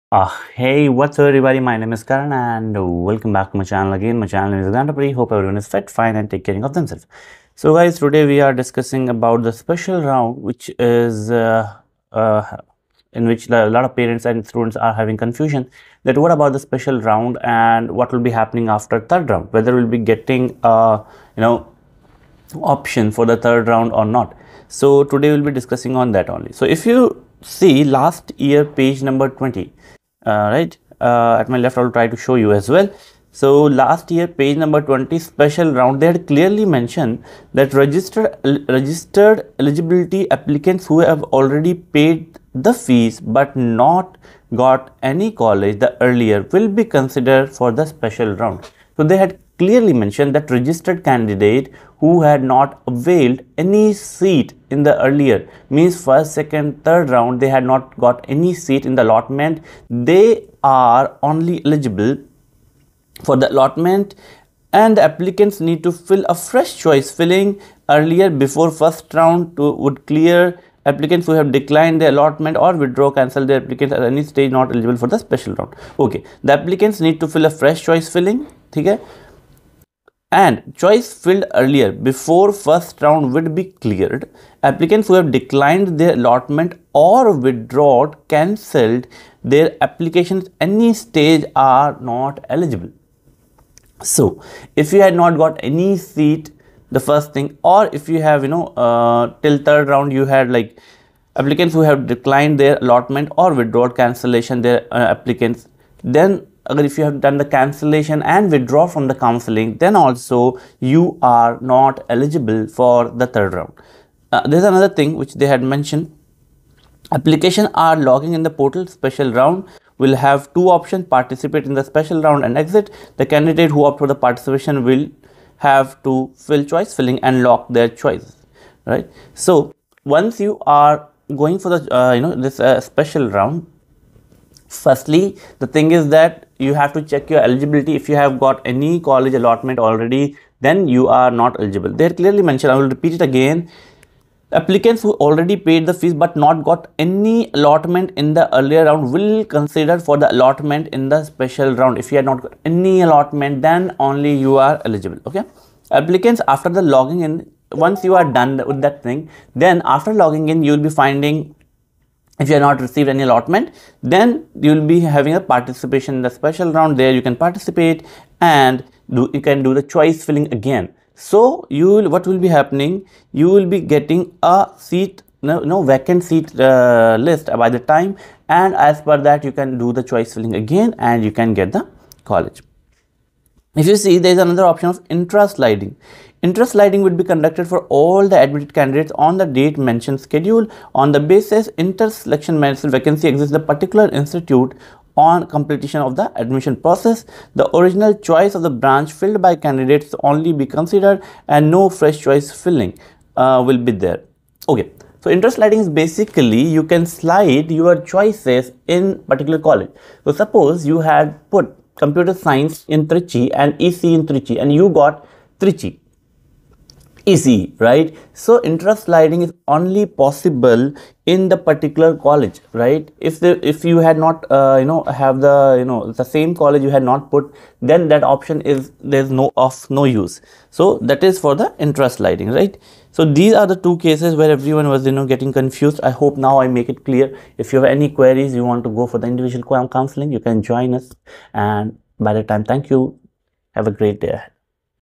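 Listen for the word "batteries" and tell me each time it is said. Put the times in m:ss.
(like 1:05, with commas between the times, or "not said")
not said.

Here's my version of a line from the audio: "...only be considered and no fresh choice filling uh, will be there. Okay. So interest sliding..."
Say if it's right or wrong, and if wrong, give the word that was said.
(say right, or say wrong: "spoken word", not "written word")
right.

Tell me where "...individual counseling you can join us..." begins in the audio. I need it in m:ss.
3:59.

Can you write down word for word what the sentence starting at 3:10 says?
On the basis, interest selection management vacancy exists the particular institute on completion of the admission process.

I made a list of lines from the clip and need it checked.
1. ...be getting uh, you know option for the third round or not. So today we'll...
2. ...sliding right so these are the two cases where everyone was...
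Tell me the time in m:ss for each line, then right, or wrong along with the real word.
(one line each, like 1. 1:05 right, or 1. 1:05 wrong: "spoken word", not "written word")
1. 0:19 right
2. 3:52 right.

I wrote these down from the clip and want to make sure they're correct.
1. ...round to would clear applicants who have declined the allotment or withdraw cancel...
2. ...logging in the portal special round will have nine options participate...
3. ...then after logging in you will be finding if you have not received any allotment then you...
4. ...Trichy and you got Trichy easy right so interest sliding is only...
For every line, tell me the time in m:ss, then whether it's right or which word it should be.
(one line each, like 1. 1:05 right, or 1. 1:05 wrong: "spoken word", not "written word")
1. 1:09 right
2. 1:57 wrong: "two", not "nine"
3. 2:39 right
4. 3:34 right.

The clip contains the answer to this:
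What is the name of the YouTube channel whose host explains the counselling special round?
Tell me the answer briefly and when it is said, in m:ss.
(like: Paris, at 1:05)
Gandapri, at 0:04.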